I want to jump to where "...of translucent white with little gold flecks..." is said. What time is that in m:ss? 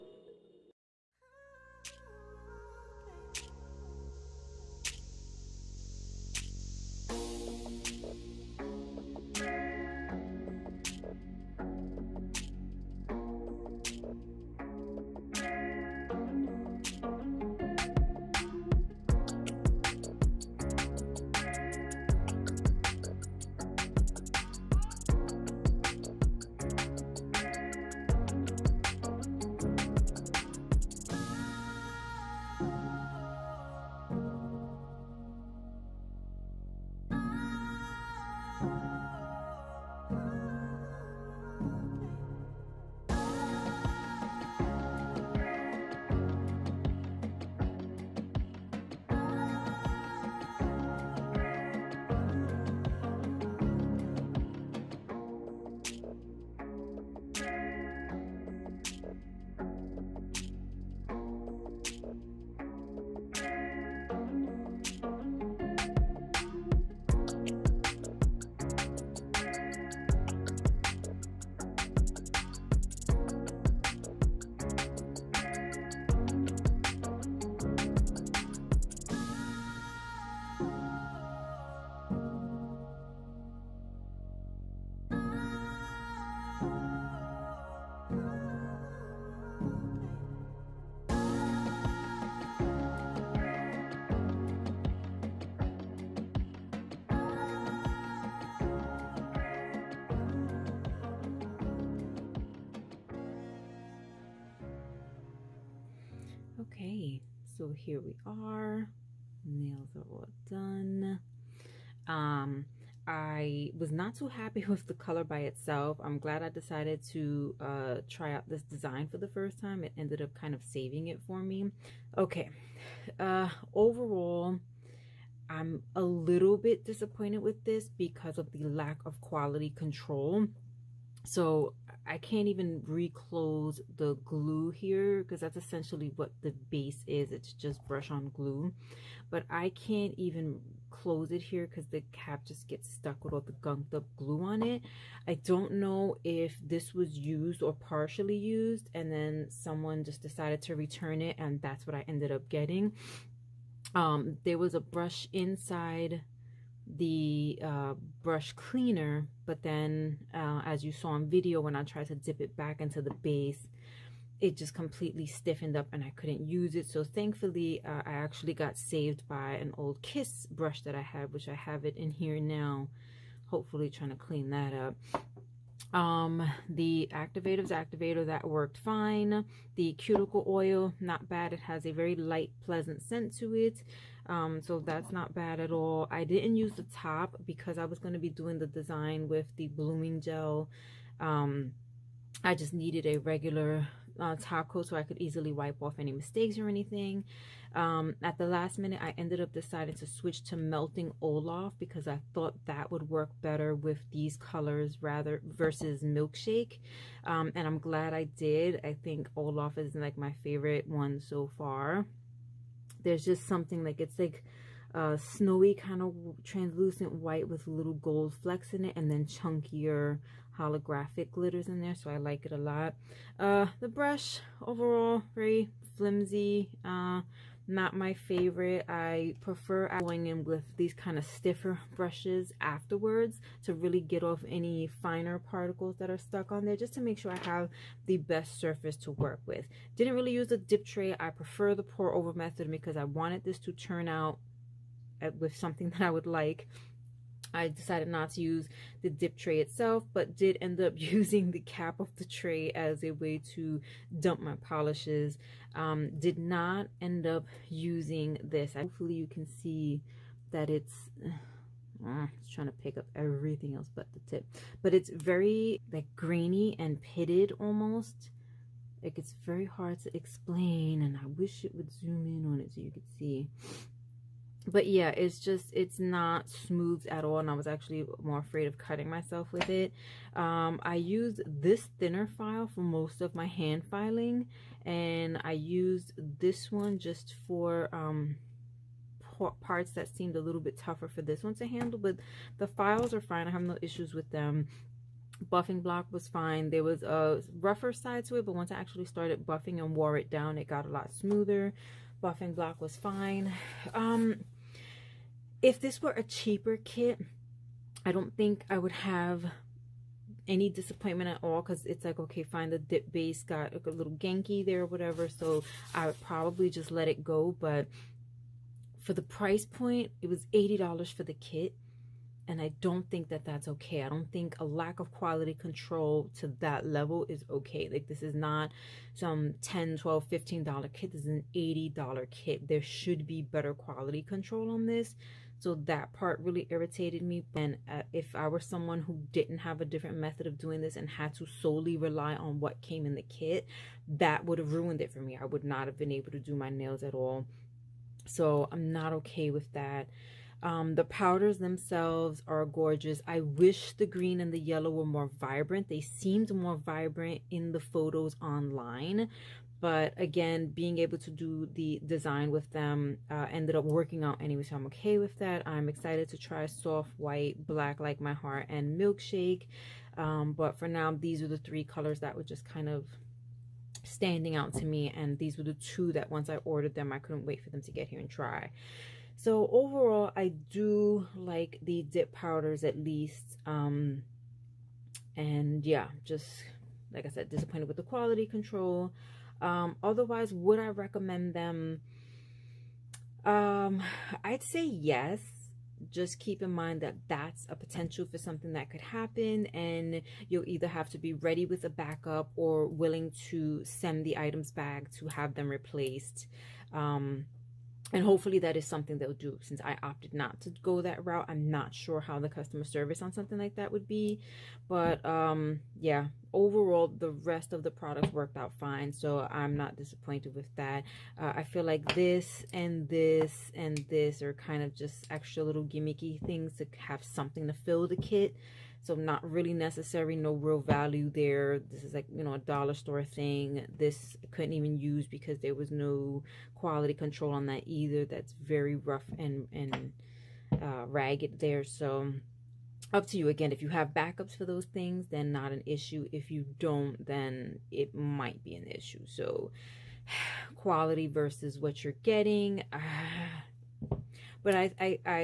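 3:36.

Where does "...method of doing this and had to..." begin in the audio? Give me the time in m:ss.
5:40.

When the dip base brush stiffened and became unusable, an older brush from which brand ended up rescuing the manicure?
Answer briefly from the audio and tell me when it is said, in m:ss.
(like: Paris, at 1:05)
Kiss, at 2:50.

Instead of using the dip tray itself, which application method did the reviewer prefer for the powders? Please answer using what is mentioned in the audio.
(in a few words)
pour over method.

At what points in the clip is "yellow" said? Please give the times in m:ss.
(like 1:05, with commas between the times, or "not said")
5:54.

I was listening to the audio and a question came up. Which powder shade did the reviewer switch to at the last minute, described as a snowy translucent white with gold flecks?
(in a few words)
Melting Olaf.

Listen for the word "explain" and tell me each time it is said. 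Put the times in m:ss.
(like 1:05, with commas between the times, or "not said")
4:30.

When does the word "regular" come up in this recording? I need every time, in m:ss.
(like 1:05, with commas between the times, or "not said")
3:13.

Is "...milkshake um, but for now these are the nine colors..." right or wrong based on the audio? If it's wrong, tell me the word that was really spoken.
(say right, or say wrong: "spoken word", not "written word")
wrong: "three", not "nine".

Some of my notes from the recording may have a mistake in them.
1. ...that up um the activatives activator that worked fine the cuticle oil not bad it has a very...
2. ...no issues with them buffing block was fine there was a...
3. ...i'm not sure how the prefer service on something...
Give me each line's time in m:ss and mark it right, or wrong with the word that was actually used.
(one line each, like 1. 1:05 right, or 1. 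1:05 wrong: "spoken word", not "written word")
1. 2:54 right
2. 4:53 right
3. 6:51 wrong: "customer", not "prefer".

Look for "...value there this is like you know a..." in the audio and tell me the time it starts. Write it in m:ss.
7:10.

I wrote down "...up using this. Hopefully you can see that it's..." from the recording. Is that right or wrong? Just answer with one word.
right.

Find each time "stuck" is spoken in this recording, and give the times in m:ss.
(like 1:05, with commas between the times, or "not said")
2:22, 3:56.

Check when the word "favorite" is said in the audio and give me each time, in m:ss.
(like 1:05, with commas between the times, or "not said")
3:30, 3:48.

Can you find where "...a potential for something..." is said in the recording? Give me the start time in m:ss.
6:37.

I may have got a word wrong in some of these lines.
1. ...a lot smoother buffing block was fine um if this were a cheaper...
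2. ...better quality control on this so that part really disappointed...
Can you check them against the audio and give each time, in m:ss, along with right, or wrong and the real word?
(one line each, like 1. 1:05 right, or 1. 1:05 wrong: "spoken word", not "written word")
1. 5:00 right
2. 5:33 wrong: "irritated", not "disappointed".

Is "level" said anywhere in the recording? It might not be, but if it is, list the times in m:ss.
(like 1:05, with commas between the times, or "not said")
5:26.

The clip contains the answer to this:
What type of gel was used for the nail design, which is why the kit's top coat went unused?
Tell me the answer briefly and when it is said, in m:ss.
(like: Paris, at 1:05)
blooming gel, at 3:09.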